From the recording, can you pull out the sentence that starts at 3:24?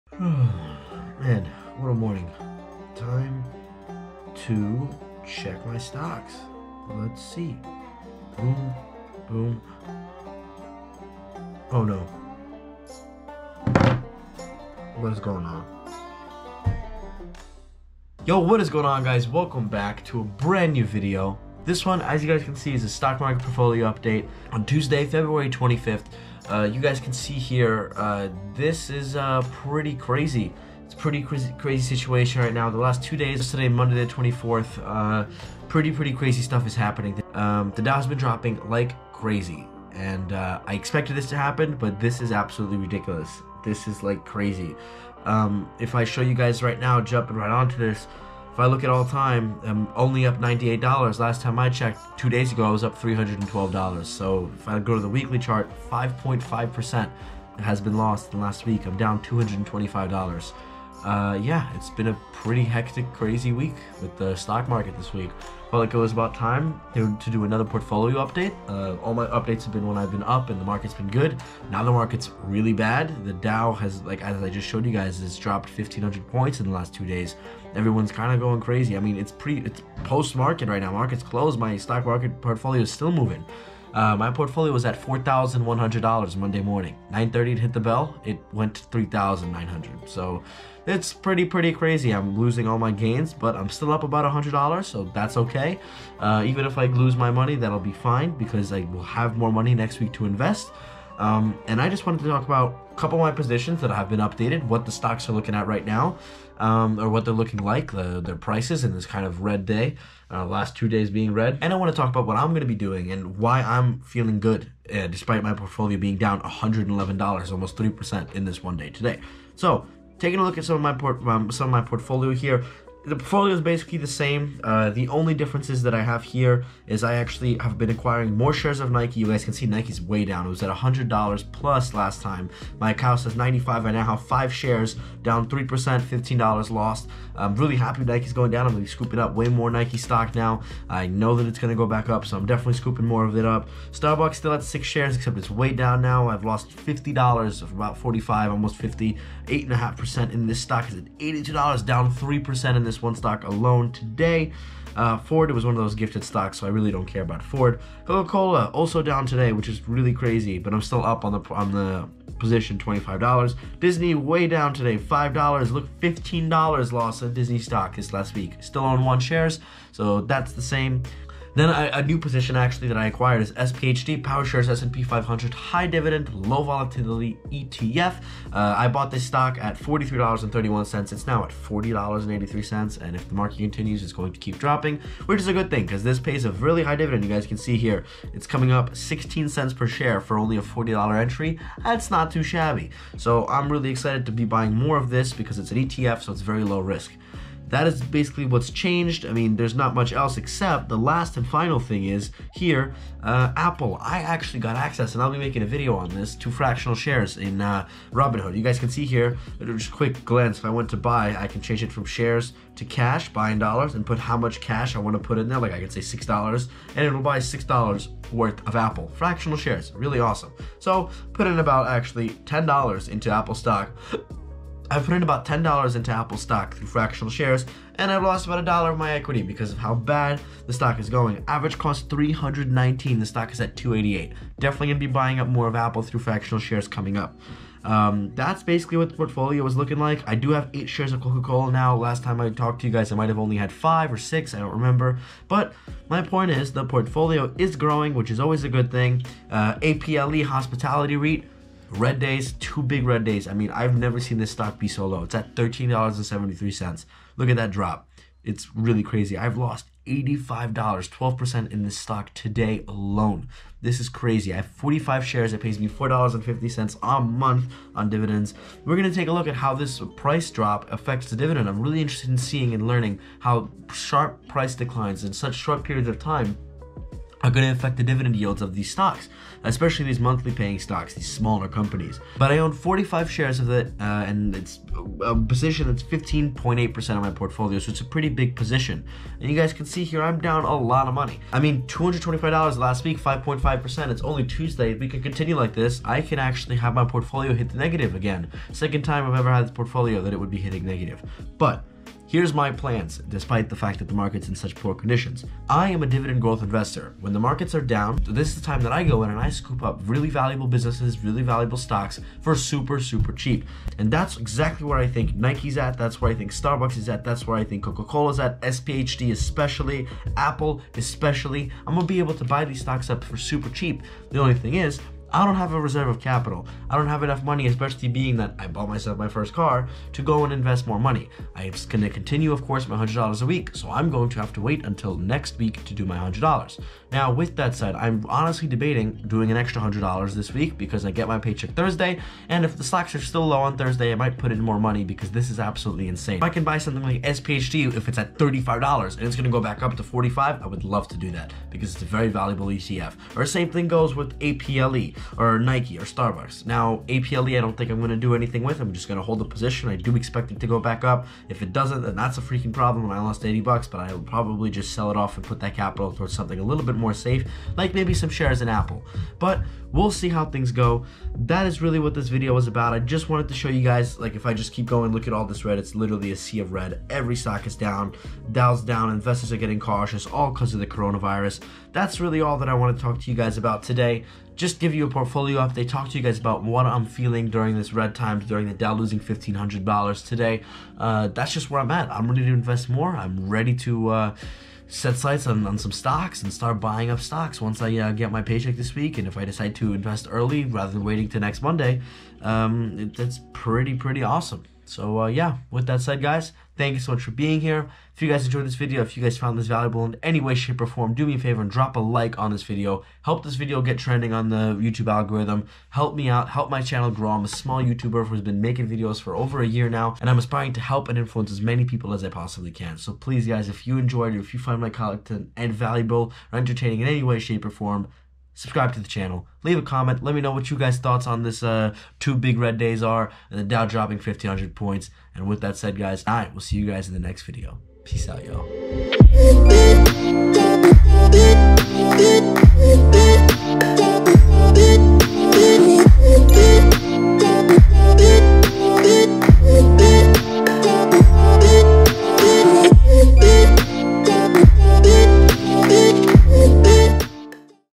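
I actually got access, and I'll be making a video on this, to fractional shares in uh, Robinhood.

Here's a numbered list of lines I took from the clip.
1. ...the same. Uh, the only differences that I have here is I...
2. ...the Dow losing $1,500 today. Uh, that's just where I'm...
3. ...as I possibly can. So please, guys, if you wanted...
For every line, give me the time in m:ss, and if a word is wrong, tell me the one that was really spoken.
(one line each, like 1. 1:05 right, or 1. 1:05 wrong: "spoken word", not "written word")
1. 2:03 right
2. 6:28 right
3. 7:02 wrong: "enjoyed", not "wanted".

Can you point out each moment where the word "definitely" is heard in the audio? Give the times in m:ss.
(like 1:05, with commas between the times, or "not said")
2:22, 3:54.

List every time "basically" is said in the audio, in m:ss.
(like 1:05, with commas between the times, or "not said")
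2:03, 3:18, 3:58.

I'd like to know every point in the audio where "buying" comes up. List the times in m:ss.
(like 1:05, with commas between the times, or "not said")
3:14, 3:55, 6:36.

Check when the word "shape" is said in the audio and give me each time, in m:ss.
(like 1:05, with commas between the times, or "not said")
6:50, 7:07.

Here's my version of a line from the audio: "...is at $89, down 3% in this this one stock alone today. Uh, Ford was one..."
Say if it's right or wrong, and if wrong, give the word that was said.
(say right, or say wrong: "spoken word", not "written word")
wrong: "82", not "89".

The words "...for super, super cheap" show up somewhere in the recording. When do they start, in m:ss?
5:12.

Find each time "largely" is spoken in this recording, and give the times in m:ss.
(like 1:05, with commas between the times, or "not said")
not said.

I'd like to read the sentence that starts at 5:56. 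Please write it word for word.
Now, APLE, I don't think I'm going to do anything with.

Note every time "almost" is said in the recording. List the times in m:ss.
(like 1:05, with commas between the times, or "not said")
1:57, 2:28.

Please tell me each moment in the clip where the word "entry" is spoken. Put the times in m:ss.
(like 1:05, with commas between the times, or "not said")
3:11.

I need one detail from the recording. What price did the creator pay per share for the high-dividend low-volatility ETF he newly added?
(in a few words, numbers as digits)
$43.31.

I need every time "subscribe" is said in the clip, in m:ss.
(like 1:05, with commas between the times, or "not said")
7:08.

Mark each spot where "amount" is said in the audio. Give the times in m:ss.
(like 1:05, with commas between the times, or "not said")
not said.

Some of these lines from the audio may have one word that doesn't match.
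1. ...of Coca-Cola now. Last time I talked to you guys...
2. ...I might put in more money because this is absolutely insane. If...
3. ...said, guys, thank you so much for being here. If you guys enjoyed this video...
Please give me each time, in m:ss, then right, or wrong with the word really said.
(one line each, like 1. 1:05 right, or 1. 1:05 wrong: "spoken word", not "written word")
1. 4:01 right
2. 5:44 right
3. 6:46 right.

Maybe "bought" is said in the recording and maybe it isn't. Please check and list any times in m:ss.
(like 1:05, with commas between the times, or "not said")
2:58, 5:28.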